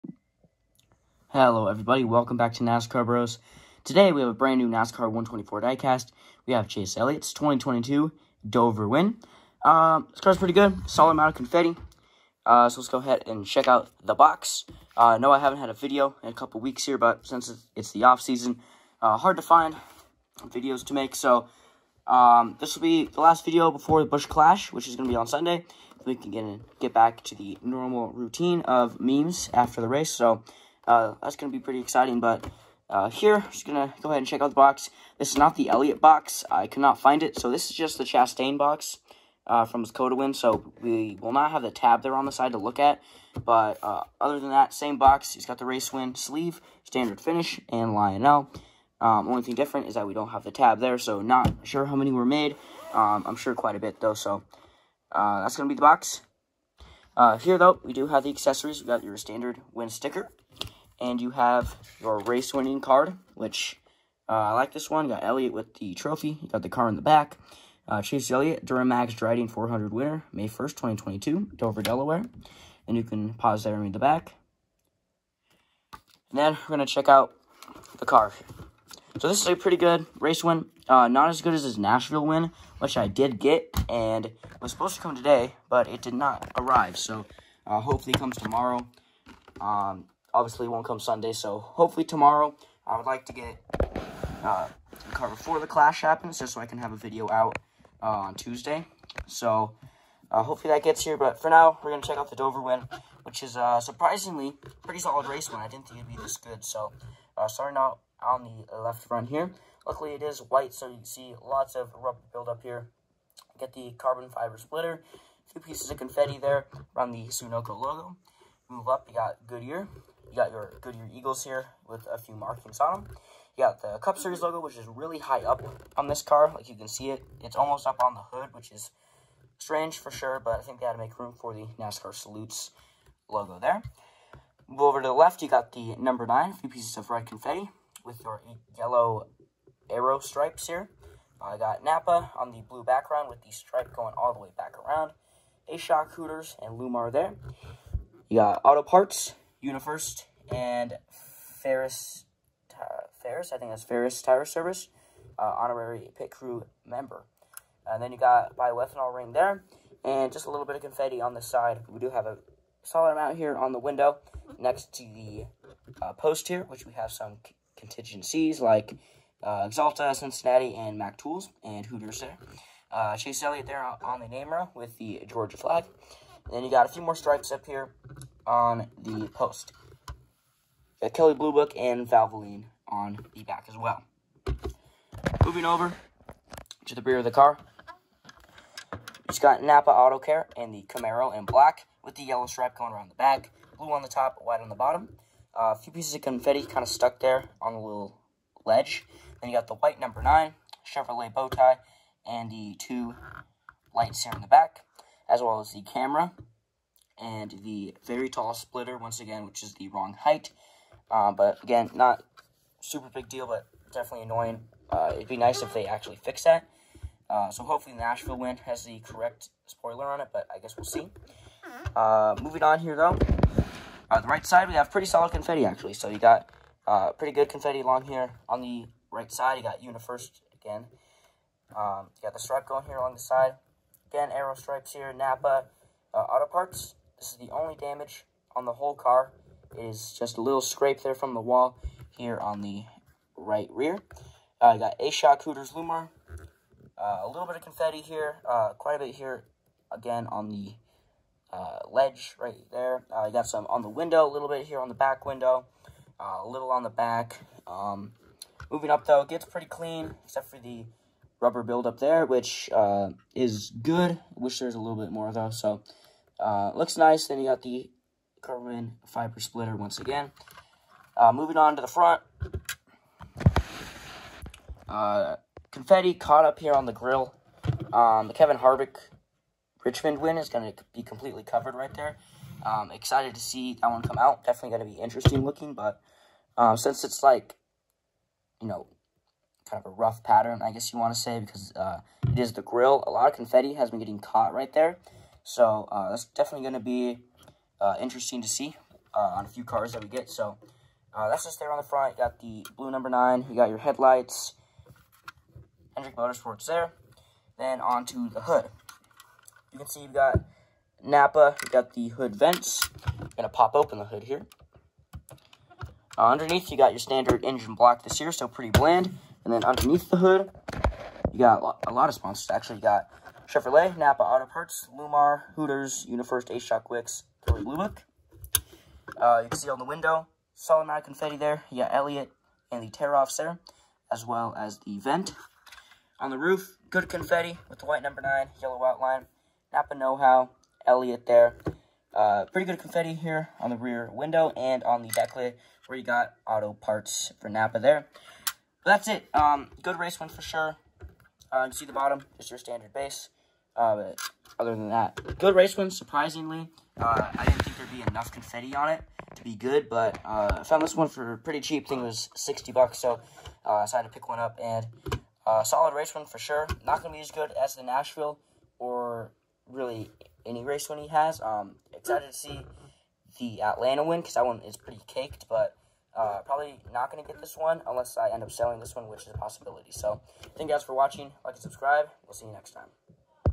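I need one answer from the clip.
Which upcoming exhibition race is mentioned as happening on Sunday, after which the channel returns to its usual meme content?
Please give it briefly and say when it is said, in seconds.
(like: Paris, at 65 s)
Busch Clash, at 24 s.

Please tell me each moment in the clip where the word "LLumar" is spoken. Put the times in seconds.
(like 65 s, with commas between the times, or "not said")
146 s, 245 s, 324 s.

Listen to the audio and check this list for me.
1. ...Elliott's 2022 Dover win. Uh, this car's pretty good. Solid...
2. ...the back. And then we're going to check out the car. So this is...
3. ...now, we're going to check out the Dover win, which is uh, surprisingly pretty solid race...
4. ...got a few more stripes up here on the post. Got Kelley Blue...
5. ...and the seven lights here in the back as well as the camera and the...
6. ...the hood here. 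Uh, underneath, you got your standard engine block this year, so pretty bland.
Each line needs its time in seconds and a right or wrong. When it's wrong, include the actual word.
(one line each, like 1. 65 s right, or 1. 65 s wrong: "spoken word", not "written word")
1. 6 s right
2. 73 s right
3. 101 s right
4. 176 s right
5. 202 s wrong: "two", not "seven"
6. 313 s right.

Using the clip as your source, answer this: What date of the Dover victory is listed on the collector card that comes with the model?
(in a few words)
May 1st, 2022.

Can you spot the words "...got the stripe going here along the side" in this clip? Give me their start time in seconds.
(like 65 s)
232 s.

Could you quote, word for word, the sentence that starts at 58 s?
we got your standard Win sticker.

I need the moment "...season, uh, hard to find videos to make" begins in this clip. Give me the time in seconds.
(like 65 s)
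18 s.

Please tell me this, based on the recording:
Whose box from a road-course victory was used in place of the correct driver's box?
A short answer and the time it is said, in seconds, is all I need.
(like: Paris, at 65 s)
Chastain, at 38 s.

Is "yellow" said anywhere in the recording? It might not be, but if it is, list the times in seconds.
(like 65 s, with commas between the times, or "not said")
138 s, 192 s, 338 s.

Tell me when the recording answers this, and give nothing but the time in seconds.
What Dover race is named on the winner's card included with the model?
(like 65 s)
68 s.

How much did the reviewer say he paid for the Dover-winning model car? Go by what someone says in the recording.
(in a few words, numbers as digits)
$60.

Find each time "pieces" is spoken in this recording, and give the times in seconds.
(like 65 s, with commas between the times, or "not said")
115 s, 136 s, 195 s.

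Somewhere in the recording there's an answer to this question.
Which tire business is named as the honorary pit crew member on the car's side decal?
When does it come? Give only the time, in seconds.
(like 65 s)
153 s.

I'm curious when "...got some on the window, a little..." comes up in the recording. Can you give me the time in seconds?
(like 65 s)
253 s.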